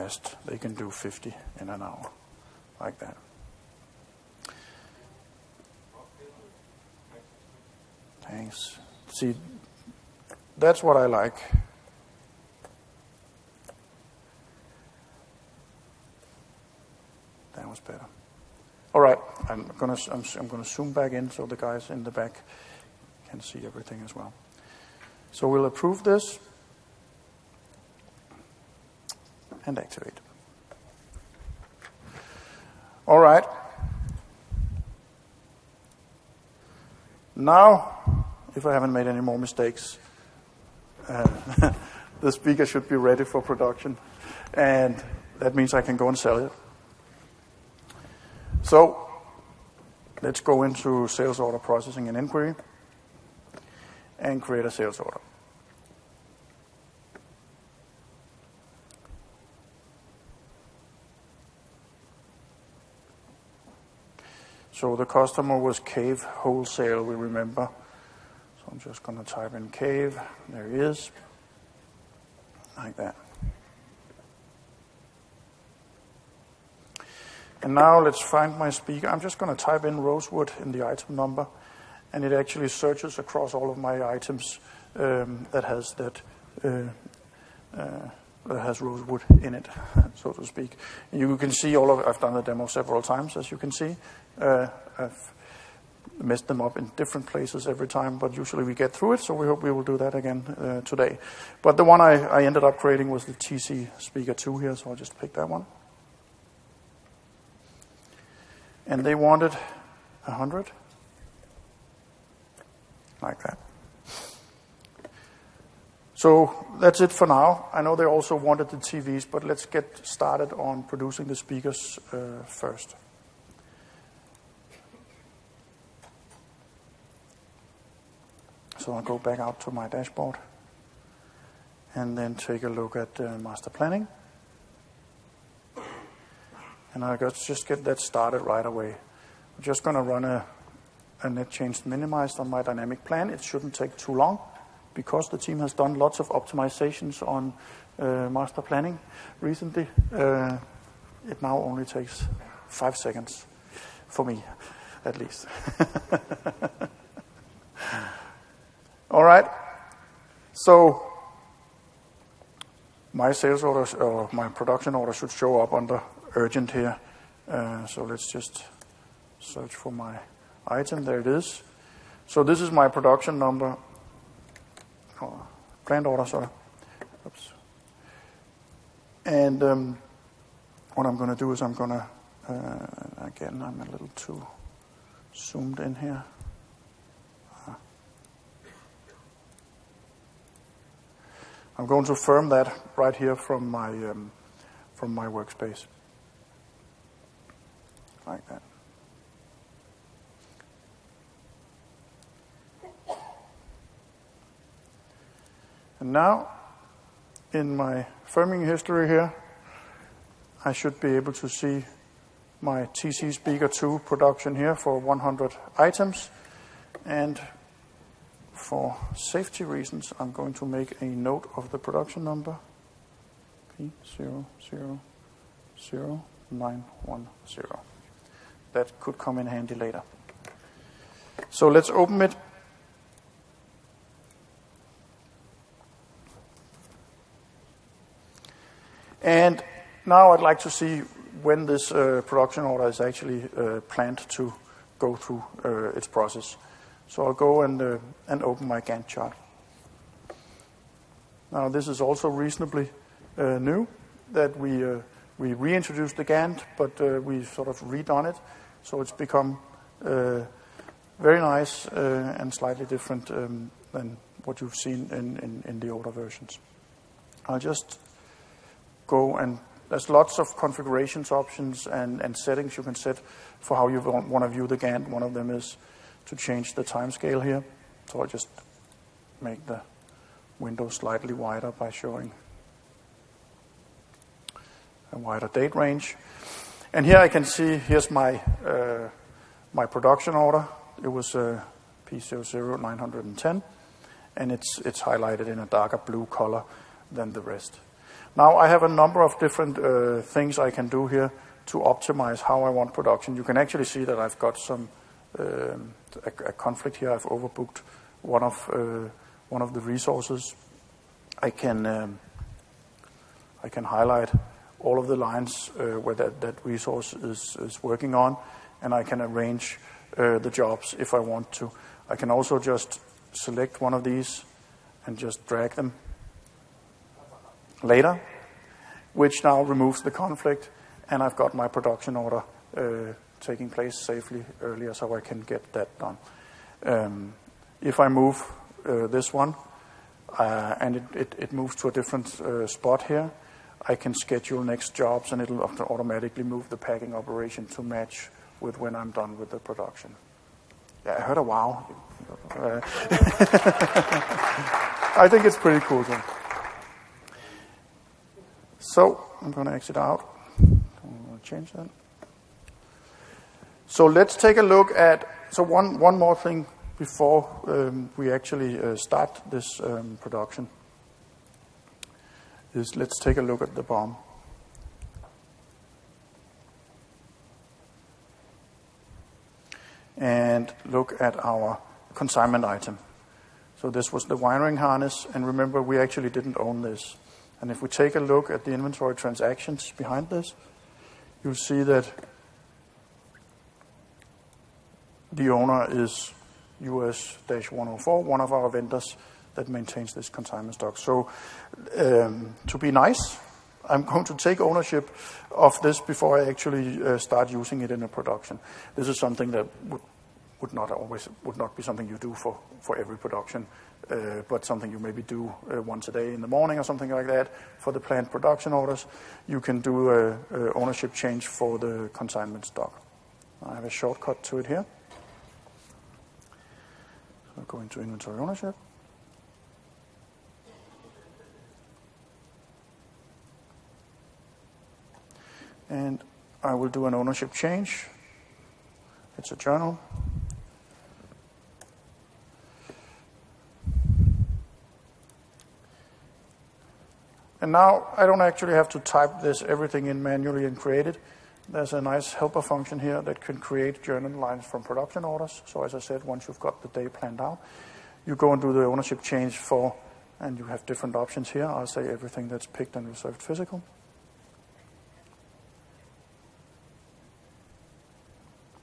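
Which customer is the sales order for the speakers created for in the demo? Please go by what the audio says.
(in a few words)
Cave Wholesale.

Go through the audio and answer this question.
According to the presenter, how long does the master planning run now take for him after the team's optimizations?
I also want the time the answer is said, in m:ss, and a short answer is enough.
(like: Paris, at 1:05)
five seconds, at 2:32.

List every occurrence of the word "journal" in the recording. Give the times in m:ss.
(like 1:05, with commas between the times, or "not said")
7:19, 7:34.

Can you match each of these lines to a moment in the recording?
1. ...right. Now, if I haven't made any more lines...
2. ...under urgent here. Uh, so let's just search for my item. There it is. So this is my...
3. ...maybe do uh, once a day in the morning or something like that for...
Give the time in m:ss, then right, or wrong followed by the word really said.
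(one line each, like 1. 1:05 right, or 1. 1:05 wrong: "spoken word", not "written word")
1. 0:33 wrong: "mistakes", not "lines"
2. 2:45 right
3. 6:54 right.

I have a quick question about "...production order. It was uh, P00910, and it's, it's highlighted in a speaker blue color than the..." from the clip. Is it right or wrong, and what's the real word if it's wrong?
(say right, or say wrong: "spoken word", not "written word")
wrong: "darker", not "speaker".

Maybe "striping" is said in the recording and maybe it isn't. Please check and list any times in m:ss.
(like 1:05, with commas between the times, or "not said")
not said.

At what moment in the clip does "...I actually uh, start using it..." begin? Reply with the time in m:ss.
6:46.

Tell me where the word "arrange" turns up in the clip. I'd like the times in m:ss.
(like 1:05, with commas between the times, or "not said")
5:19.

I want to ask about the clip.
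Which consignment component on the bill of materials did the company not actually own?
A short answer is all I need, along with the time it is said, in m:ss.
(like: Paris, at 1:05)
wiring harness, at 6:24.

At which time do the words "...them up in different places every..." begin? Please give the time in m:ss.
1:36.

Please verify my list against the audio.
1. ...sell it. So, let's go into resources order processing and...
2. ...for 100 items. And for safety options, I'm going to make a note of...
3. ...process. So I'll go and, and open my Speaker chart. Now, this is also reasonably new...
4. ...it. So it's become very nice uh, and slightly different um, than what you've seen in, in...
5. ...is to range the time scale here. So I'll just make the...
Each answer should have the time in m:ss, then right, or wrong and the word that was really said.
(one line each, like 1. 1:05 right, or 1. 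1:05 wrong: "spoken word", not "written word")
1. 0:46 wrong: "sales", not "resources"
2. 3:34 wrong: "reasons", not "options"
3. 4:06 wrong: "Gantt", not "Speaker"
4. 4:18 right
5. 4:35 wrong: "change", not "range".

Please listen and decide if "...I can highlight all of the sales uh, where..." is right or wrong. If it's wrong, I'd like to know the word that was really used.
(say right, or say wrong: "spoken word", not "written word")
wrong: "lines", not "sales".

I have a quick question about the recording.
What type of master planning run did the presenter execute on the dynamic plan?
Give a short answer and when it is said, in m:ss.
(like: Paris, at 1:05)
net change minimized, at 2:21.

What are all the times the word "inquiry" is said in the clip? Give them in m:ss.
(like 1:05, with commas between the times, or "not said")
0:52.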